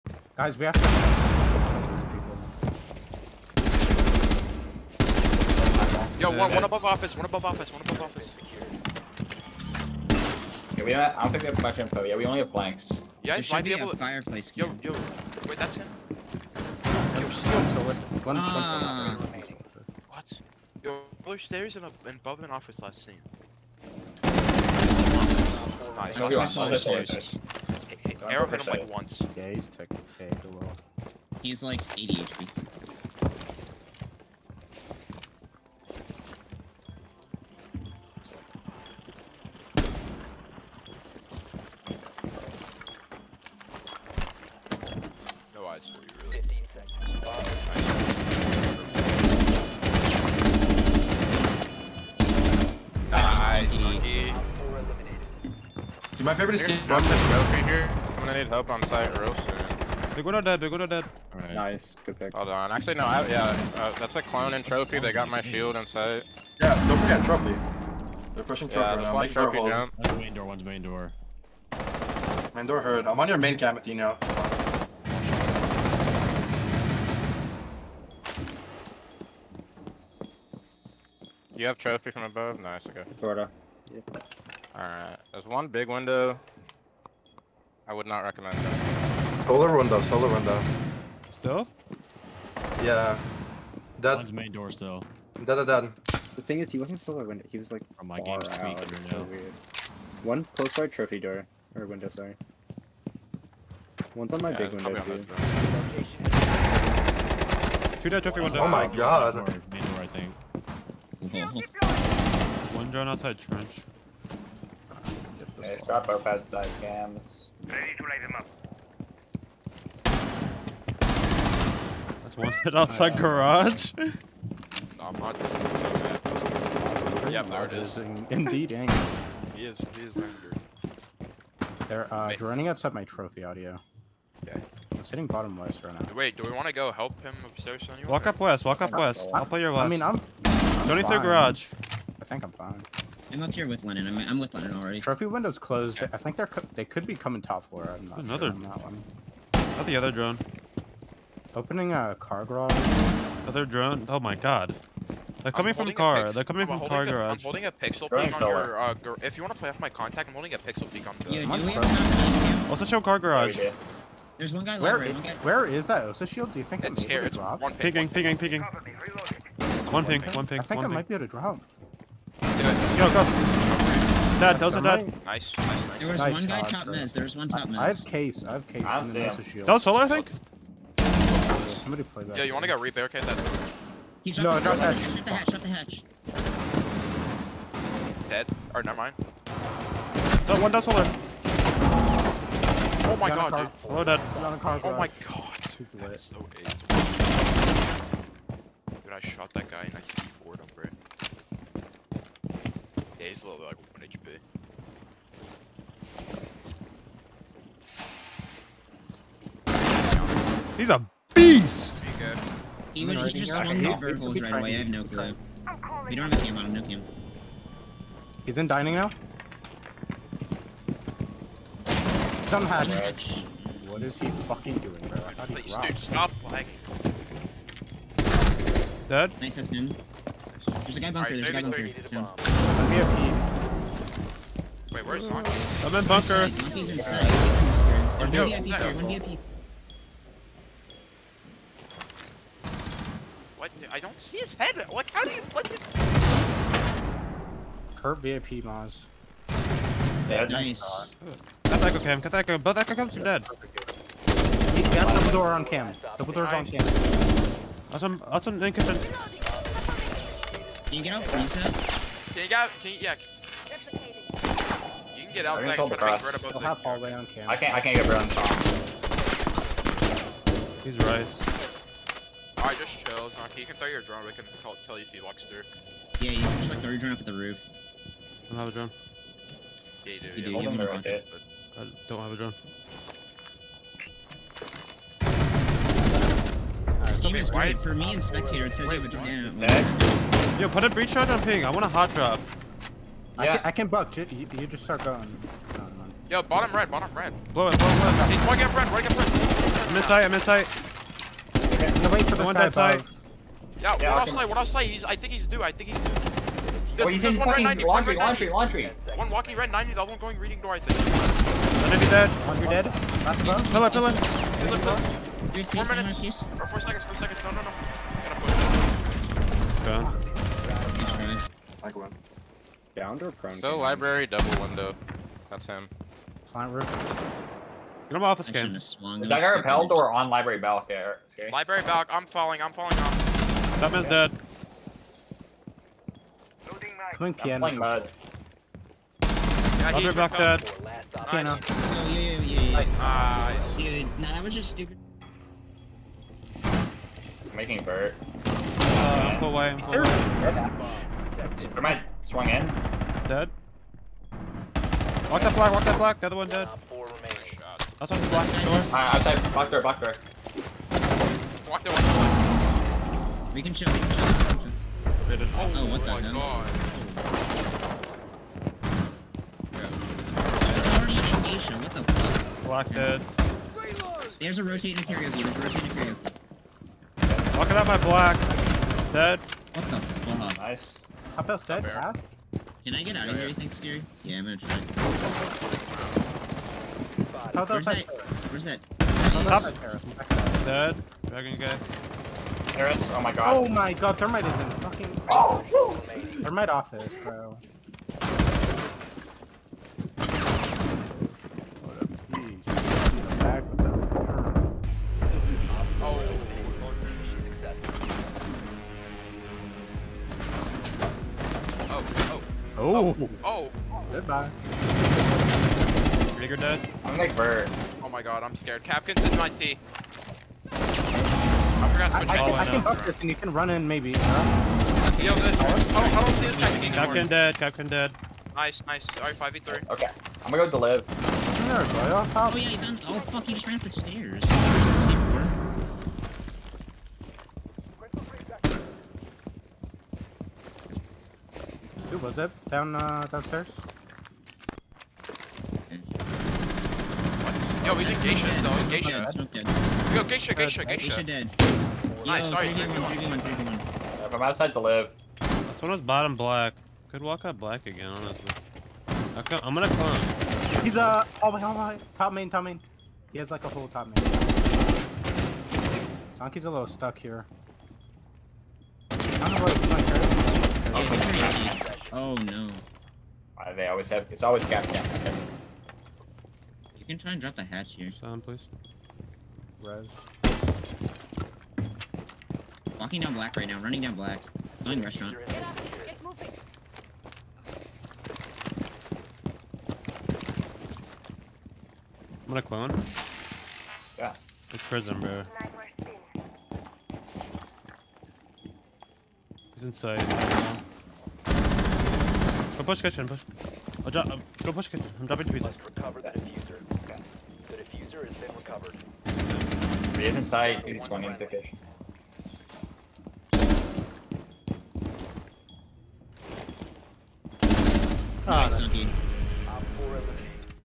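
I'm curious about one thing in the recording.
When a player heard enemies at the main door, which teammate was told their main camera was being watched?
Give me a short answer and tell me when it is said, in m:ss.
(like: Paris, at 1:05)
Athena, at 1:13.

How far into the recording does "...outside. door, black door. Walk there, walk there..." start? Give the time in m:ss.
5:59.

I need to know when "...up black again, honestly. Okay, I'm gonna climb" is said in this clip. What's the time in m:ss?
7:37.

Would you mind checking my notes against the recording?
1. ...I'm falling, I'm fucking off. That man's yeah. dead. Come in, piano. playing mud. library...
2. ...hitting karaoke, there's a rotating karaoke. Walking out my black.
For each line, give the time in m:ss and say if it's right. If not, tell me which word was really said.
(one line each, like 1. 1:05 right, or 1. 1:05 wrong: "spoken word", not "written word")
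1. 5:32 wrong: "falling", not "fucking"
2. 6:14 wrong: "rotating", not "hitting".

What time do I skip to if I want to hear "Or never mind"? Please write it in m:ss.
3:08.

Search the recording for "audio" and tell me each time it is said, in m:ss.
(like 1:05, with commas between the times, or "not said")
2:13.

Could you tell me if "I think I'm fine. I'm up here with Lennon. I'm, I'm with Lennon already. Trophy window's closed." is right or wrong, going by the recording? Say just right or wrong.
right.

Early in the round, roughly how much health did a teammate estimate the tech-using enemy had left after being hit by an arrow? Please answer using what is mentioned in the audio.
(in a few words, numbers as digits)
80 HP.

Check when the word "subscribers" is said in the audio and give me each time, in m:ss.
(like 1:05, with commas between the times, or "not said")
not said.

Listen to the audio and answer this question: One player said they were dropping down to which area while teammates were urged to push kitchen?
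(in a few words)
pizza.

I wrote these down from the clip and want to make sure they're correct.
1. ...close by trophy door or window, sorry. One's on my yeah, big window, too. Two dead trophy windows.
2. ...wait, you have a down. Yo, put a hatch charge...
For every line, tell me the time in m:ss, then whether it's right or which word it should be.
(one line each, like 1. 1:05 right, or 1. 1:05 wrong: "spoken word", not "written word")
1. 1:40 right
2. 4:48 wrong: "breach", not "hatch".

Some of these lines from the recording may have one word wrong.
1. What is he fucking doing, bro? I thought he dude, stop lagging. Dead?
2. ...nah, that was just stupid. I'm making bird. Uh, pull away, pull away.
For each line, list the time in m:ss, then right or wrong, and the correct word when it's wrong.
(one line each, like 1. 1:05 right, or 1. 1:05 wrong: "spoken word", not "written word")
1. 3:43 right
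2. 5:44 right.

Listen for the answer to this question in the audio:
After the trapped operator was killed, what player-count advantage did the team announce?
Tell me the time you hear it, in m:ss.
7:09.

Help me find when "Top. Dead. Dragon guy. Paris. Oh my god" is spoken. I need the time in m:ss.
6:28.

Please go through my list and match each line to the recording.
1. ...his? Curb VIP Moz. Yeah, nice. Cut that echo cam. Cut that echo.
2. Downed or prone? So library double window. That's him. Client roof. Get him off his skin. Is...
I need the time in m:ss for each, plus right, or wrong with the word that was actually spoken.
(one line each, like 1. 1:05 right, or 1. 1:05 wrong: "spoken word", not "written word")
1. 4:05 right
2. 5:22 right.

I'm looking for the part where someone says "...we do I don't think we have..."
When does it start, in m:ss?
0:10.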